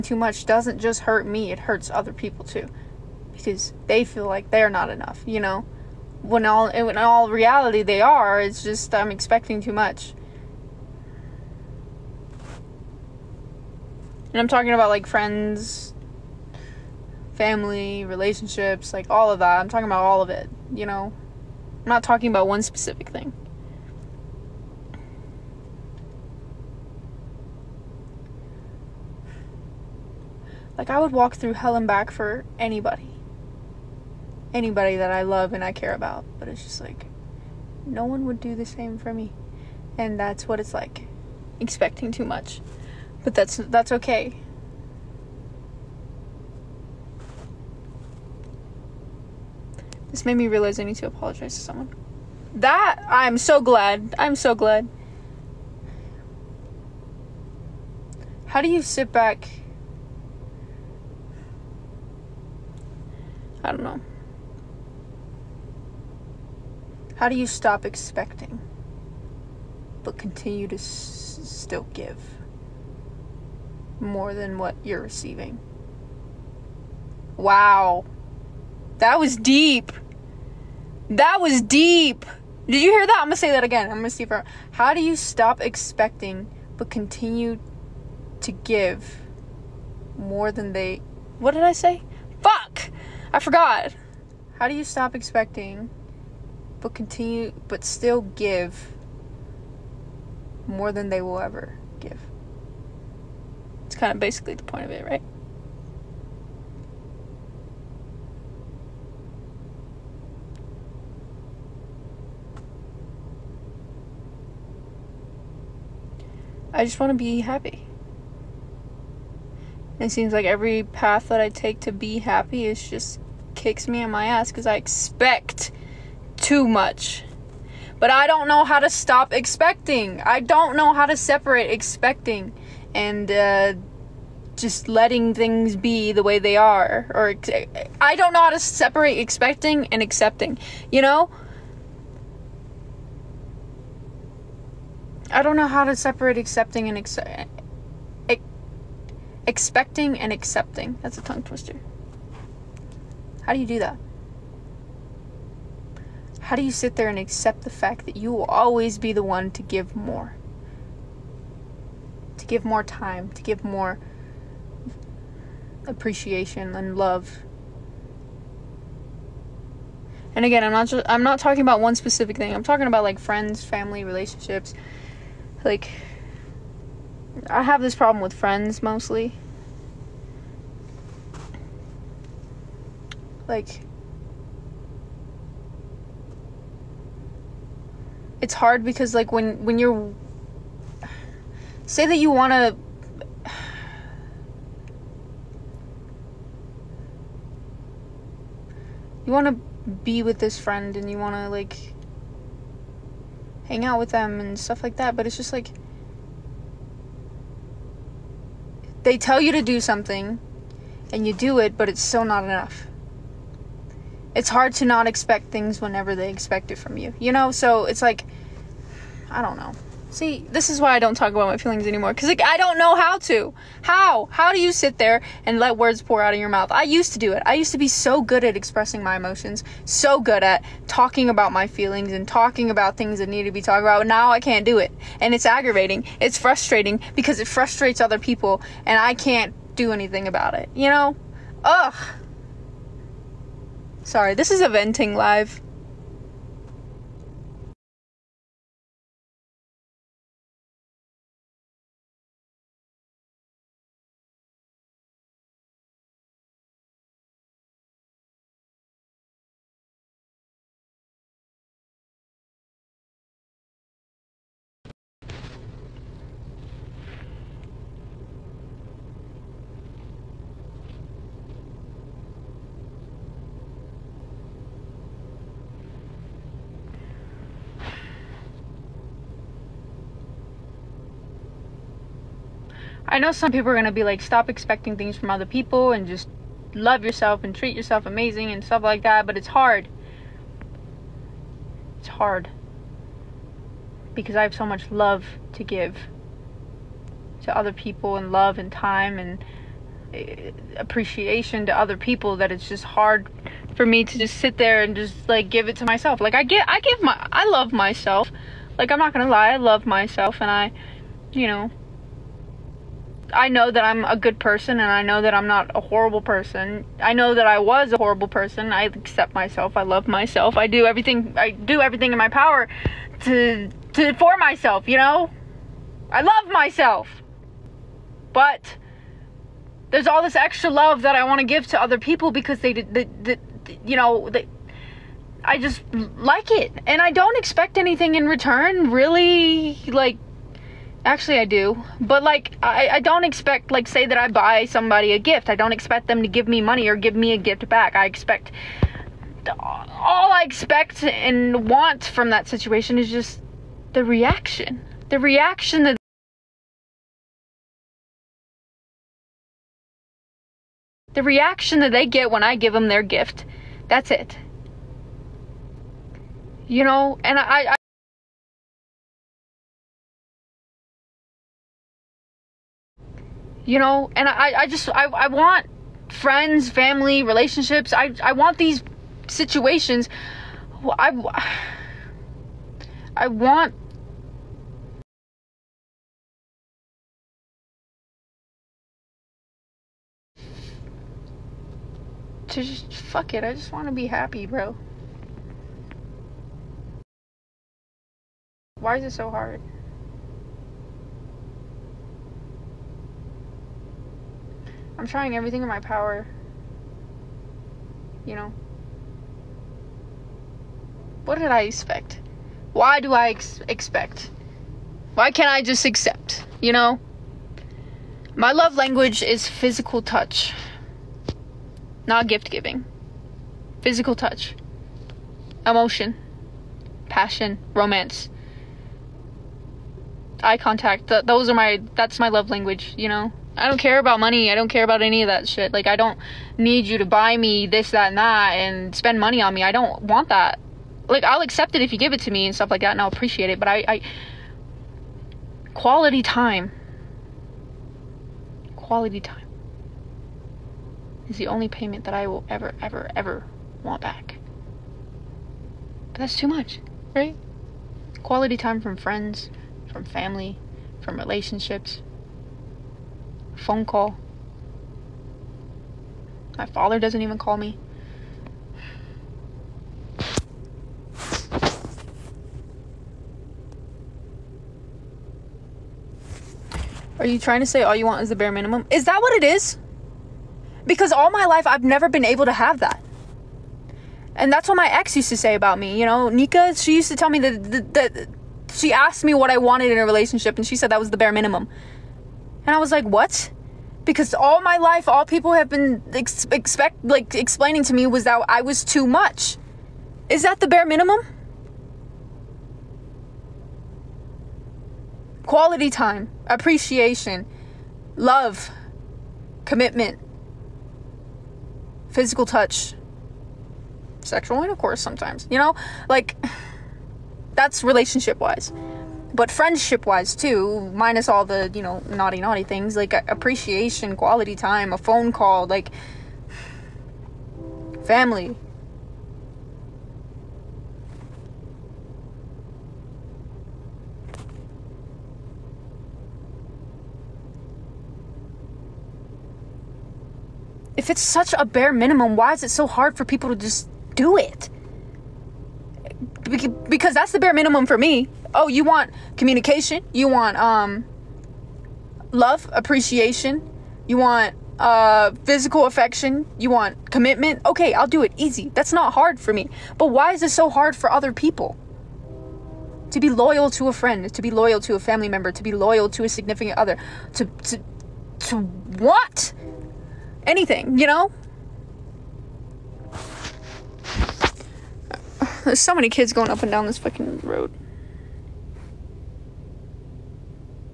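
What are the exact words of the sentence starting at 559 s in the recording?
But why is it so hard for other people?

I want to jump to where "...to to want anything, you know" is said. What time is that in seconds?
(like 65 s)
567 s.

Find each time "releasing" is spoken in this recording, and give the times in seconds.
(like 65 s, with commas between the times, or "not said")
not said.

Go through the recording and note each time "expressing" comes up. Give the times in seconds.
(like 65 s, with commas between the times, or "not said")
228 s.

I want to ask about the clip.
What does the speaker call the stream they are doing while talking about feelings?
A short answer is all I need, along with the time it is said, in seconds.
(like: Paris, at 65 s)
A venting live, at 244 s.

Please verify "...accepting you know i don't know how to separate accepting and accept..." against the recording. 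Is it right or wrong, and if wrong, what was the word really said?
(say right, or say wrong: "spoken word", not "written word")
right.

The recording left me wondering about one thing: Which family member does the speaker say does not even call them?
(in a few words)
Father.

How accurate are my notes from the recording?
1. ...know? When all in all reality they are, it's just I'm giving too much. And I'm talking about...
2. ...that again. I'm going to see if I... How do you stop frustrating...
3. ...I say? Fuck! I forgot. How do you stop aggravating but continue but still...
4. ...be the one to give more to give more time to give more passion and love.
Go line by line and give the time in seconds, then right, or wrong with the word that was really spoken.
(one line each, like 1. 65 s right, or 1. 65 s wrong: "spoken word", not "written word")
1. 5 s wrong: "expecting", not "giving"
2. 83 s wrong: "expecting", not "frustrating"
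3. 91 s wrong: "expecting", not "aggravating"
4. 158 s wrong: "appreciation", not "passion".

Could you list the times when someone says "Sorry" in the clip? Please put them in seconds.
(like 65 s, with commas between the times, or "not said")
244 s.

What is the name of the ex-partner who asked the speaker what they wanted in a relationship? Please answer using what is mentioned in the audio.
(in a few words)
Nika.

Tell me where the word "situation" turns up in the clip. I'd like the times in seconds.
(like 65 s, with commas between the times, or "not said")
352 s, 379 s.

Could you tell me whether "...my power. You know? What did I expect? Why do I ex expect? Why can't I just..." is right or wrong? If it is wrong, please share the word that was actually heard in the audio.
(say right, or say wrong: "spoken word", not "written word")
right.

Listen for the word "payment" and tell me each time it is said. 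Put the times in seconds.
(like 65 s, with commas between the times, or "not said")
451 s.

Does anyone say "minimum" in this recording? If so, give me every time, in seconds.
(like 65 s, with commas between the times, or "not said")
478 s, 491 s, 500 s, 541 s, 547 s.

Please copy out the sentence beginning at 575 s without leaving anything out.
There's so many kids going up and down this fucking road.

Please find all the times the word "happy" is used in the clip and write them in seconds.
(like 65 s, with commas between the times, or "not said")
117 s, 122 s, 394 s.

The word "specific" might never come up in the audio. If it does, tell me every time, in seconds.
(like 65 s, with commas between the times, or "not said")
22 s, 171 s.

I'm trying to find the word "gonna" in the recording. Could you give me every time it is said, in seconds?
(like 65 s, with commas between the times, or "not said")
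283 s.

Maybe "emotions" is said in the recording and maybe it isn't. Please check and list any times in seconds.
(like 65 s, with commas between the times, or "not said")
229 s, 425 s.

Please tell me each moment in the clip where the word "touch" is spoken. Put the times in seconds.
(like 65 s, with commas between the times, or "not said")
420 s, 424 s, 512 s.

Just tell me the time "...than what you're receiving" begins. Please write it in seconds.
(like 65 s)
74 s.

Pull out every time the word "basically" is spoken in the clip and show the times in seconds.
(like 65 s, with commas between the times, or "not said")
104 s.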